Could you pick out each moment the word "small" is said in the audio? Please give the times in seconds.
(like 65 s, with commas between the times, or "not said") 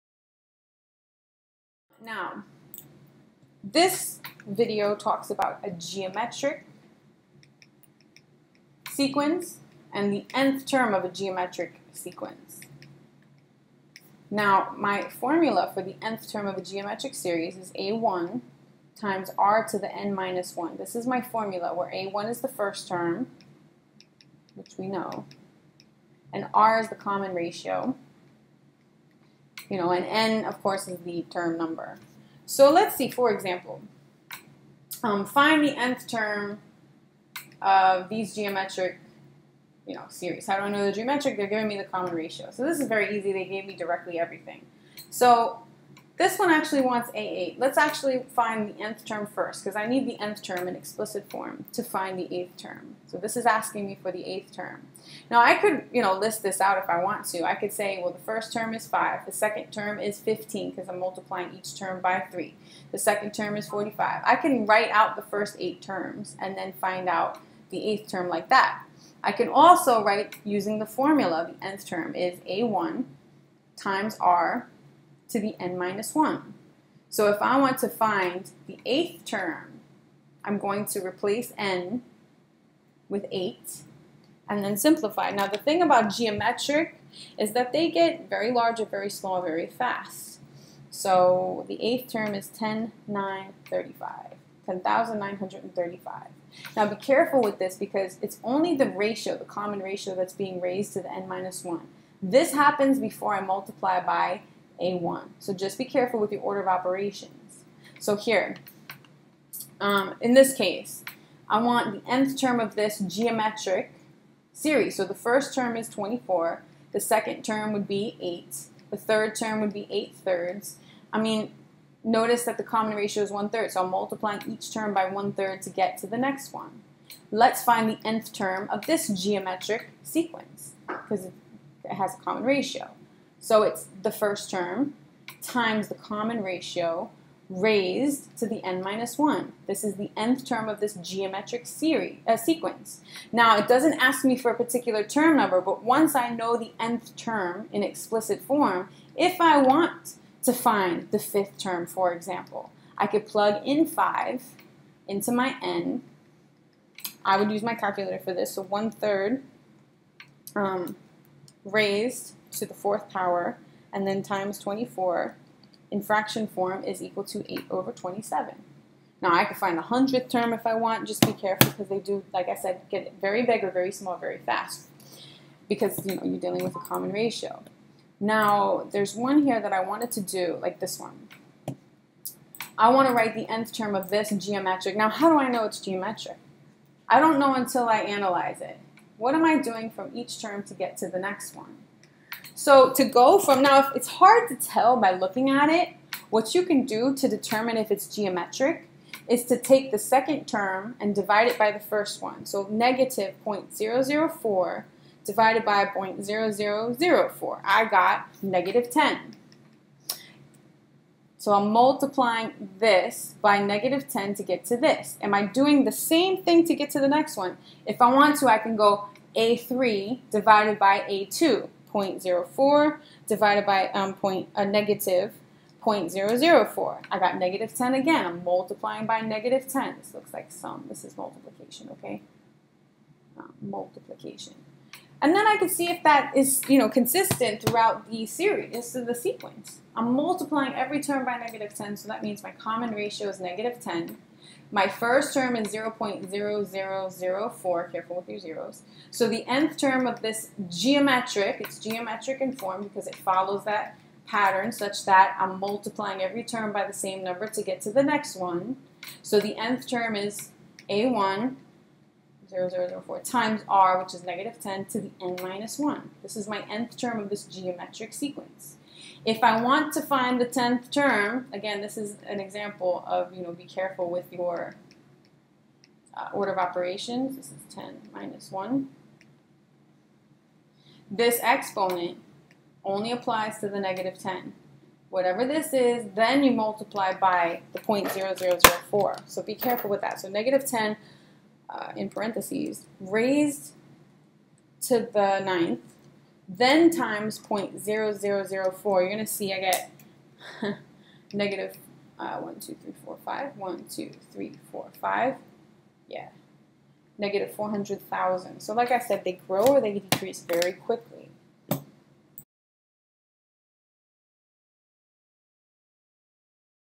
89 s, 173 s.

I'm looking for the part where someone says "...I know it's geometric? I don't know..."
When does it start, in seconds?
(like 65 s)
185 s.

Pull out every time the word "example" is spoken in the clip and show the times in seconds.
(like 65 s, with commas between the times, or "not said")
33 s, 152 s, 272 s.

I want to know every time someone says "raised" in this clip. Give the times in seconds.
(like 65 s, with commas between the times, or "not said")
100 s, 137 s, 161 s, 293 s.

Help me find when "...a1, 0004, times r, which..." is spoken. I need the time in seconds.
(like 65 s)
260 s.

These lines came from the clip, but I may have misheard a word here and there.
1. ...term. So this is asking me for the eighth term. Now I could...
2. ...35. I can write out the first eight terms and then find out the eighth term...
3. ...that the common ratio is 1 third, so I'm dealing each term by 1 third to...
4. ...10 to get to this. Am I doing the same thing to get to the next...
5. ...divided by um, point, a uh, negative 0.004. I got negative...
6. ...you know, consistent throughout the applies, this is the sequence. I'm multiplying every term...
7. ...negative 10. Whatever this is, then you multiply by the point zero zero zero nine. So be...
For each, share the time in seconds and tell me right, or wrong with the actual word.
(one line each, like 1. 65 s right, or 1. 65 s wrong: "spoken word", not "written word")
1. 52 s right
2. 63 s wrong: "45", not "35"
3. 122 s wrong: "multiplying", not "dealing"
4. 214 s right
5. 223 s right
6. 236 s wrong: "series", not "applies"
7. 283 s wrong: "four", not "nine".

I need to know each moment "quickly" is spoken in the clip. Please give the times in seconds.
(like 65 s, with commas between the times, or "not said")
310 s.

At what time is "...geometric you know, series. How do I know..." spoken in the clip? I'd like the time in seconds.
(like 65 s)
38 s.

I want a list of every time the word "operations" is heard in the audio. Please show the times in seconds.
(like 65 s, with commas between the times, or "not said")
106 s, 276 s.